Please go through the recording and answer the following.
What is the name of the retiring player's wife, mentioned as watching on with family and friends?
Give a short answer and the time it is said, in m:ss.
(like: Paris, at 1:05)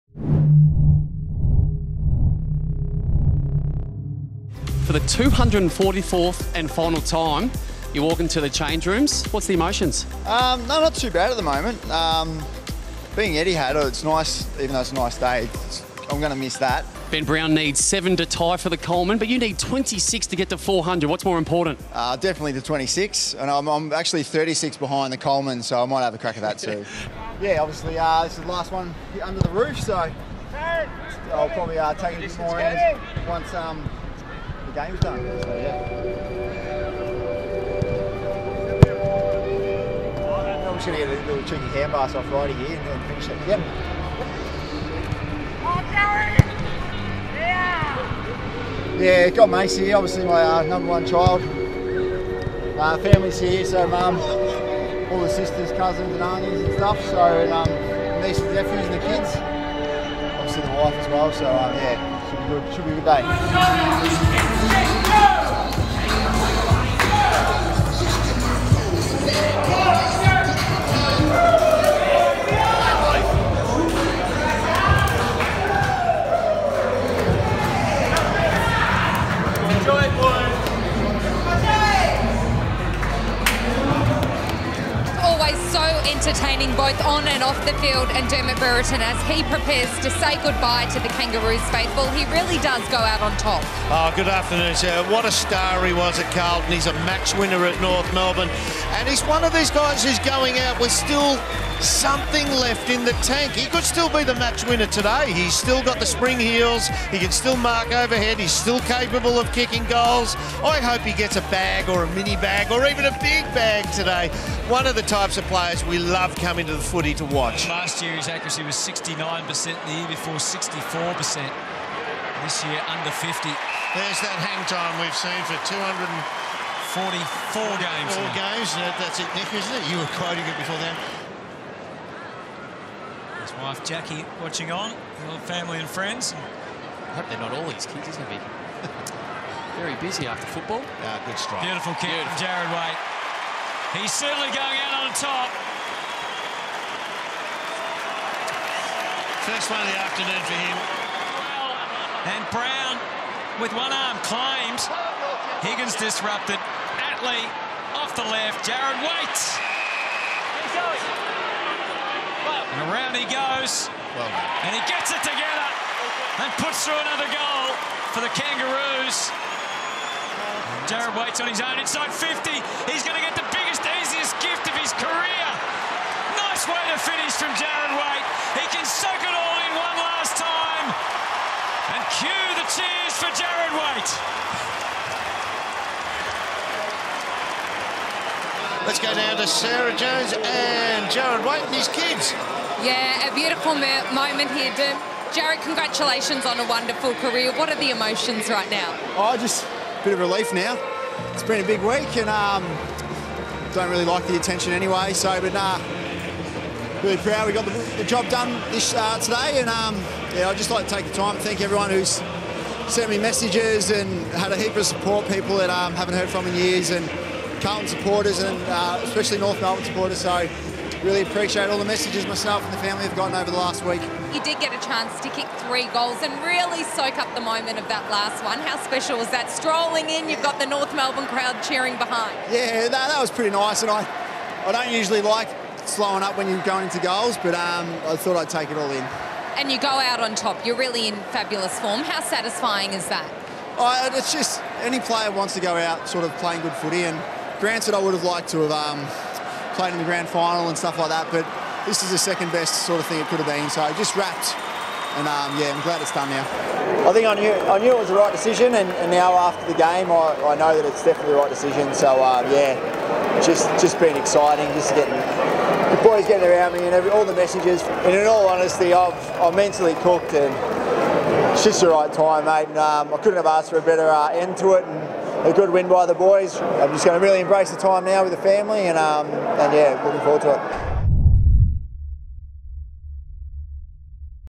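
Jackie, at 2:13.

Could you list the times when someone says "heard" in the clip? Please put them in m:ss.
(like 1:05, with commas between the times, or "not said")
3:36.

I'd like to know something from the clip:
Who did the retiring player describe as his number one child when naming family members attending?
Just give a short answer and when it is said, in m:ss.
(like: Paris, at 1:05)
Macy, at 0:49.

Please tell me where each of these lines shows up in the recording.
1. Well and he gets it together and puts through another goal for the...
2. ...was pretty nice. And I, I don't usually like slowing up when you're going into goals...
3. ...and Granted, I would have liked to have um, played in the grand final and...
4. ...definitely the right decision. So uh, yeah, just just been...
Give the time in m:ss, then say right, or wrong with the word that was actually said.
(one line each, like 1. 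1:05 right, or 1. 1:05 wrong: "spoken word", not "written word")
1. 2:44 right
2. 3:53 right
3. 4:07 right
4. 4:21 right.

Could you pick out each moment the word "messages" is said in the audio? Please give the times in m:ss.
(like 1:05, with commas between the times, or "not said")
3:33, 3:41, 4:27.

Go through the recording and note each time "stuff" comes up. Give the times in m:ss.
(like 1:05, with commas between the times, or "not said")
0:56, 4:10.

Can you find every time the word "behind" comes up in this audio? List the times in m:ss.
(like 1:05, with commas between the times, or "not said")
0:24, 3:51.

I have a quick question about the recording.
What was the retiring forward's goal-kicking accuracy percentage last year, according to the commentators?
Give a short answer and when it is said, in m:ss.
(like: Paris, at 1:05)
69%, at 1:58.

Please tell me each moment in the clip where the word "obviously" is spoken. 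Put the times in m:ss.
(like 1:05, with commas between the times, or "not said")
0:27, 0:49.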